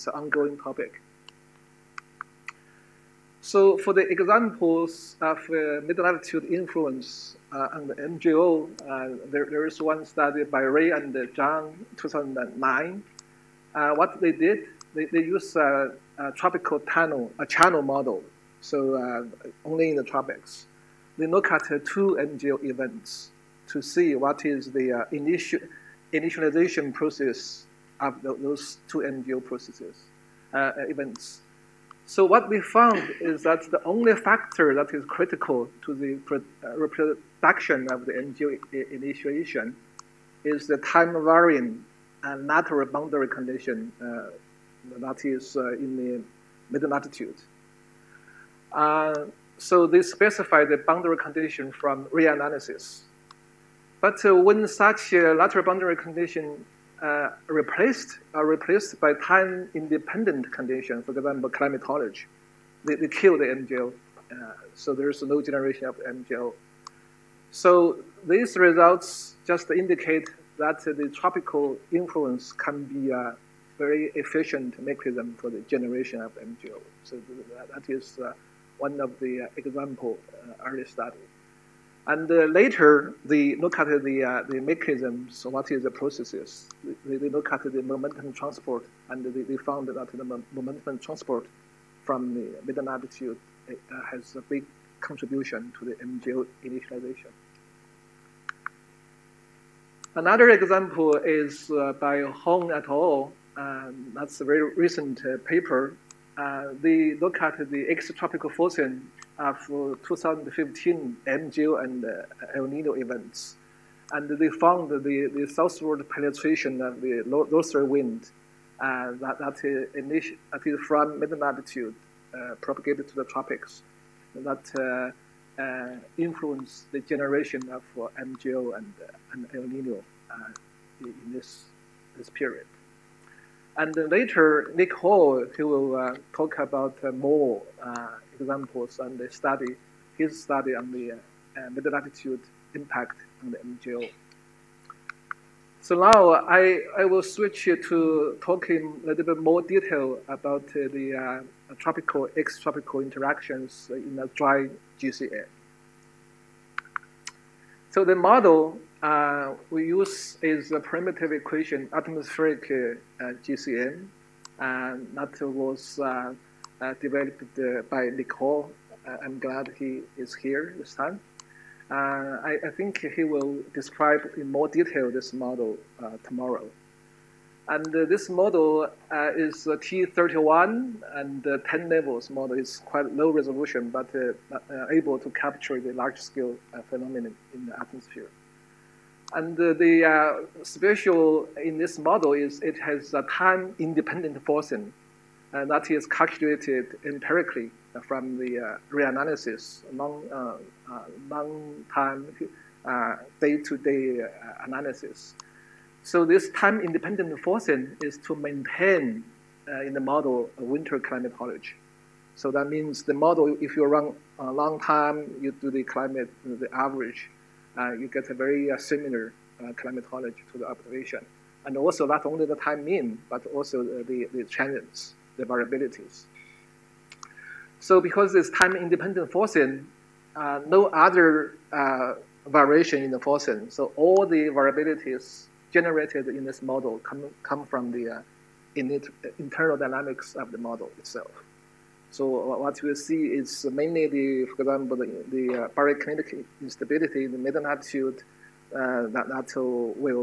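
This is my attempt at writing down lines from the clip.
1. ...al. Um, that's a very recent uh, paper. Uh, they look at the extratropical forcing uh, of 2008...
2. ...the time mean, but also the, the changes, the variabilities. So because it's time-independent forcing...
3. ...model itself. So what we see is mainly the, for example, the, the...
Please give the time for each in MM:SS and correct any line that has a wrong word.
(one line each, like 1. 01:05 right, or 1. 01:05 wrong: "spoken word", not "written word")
1. 01:42 wrong: "2015", not "2008"
2. 03:42 right
3. 04:00 right.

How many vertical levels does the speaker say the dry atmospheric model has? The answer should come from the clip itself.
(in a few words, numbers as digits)
10.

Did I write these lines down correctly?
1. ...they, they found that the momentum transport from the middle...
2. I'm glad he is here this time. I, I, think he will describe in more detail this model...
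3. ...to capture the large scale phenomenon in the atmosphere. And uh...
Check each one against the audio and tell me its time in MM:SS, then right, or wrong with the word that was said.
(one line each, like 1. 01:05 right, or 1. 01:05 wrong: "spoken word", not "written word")
1. 01:29 right
2. 02:49 right
3. 03:05 right.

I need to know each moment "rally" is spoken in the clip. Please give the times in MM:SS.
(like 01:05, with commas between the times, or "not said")
not said.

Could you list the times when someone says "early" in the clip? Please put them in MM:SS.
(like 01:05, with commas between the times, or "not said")
01:20.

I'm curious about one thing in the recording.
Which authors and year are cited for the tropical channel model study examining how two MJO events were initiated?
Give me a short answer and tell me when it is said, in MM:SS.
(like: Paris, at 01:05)
Ray and Zhang 2009, at 00:10.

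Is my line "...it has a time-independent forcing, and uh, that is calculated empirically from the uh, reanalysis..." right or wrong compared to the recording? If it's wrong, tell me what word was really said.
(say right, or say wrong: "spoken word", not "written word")
right.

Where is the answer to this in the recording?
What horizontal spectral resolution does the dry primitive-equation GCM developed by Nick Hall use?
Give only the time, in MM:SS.
02:59.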